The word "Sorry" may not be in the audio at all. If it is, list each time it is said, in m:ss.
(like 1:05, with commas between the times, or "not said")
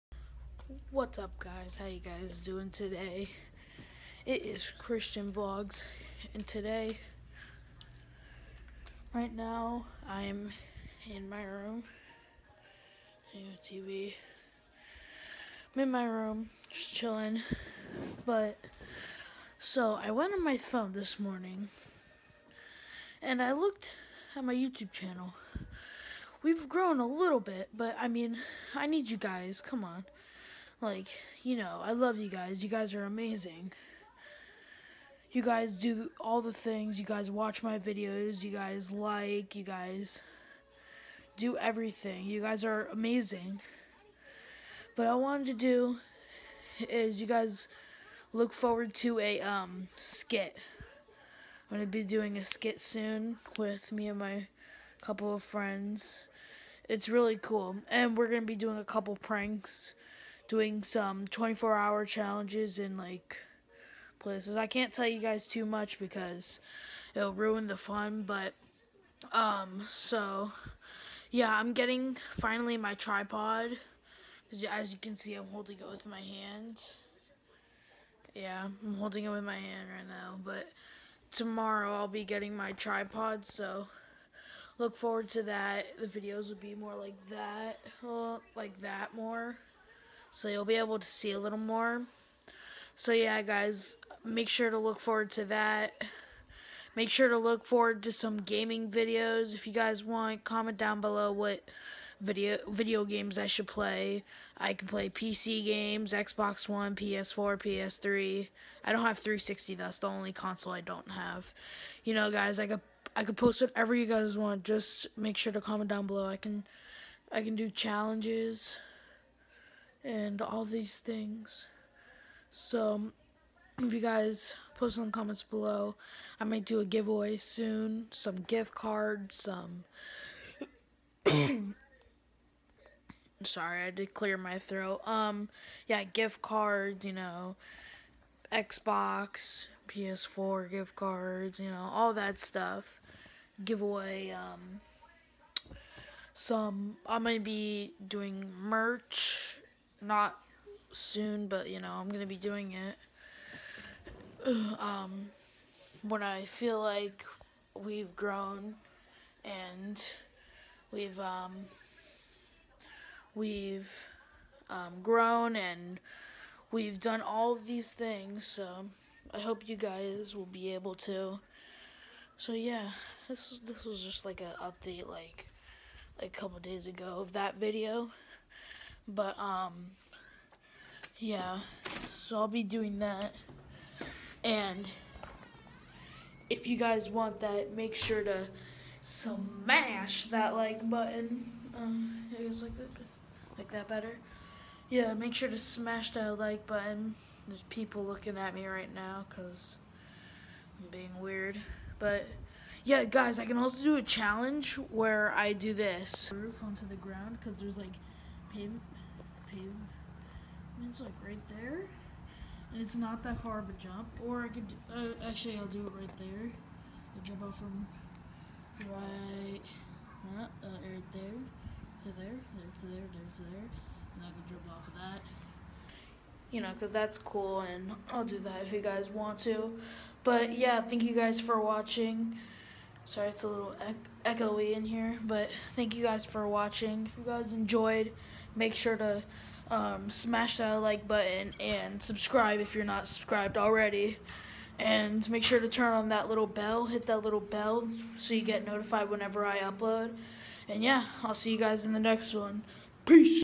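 2:13, 3:53.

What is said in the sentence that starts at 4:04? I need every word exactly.
And make sure to turn on that little bell, hit that little bell so you get notified whenever I upload.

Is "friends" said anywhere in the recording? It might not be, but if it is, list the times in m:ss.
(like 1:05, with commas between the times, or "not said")
0:55.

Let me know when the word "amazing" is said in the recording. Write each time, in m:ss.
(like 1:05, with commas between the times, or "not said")
0:33, 0:42.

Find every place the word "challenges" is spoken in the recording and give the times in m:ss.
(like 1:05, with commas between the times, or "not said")
1:02, 1:57, 3:24.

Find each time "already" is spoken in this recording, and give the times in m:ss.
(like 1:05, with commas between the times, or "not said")
4:03.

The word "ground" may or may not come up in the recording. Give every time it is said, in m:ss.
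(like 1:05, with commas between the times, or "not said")
3:26.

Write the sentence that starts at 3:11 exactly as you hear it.
Um, I guess like that, like that better.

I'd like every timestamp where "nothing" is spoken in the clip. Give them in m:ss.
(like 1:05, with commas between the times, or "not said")
not said.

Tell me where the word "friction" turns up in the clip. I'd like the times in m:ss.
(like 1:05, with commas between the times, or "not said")
not said.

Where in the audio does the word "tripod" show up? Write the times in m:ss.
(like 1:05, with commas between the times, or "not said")
1:12, 1:22.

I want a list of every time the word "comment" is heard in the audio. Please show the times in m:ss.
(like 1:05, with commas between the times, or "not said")
1:40, 1:55, 2:05.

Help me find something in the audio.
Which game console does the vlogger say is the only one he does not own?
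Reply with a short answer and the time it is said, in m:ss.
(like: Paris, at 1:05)
360, at 1:49.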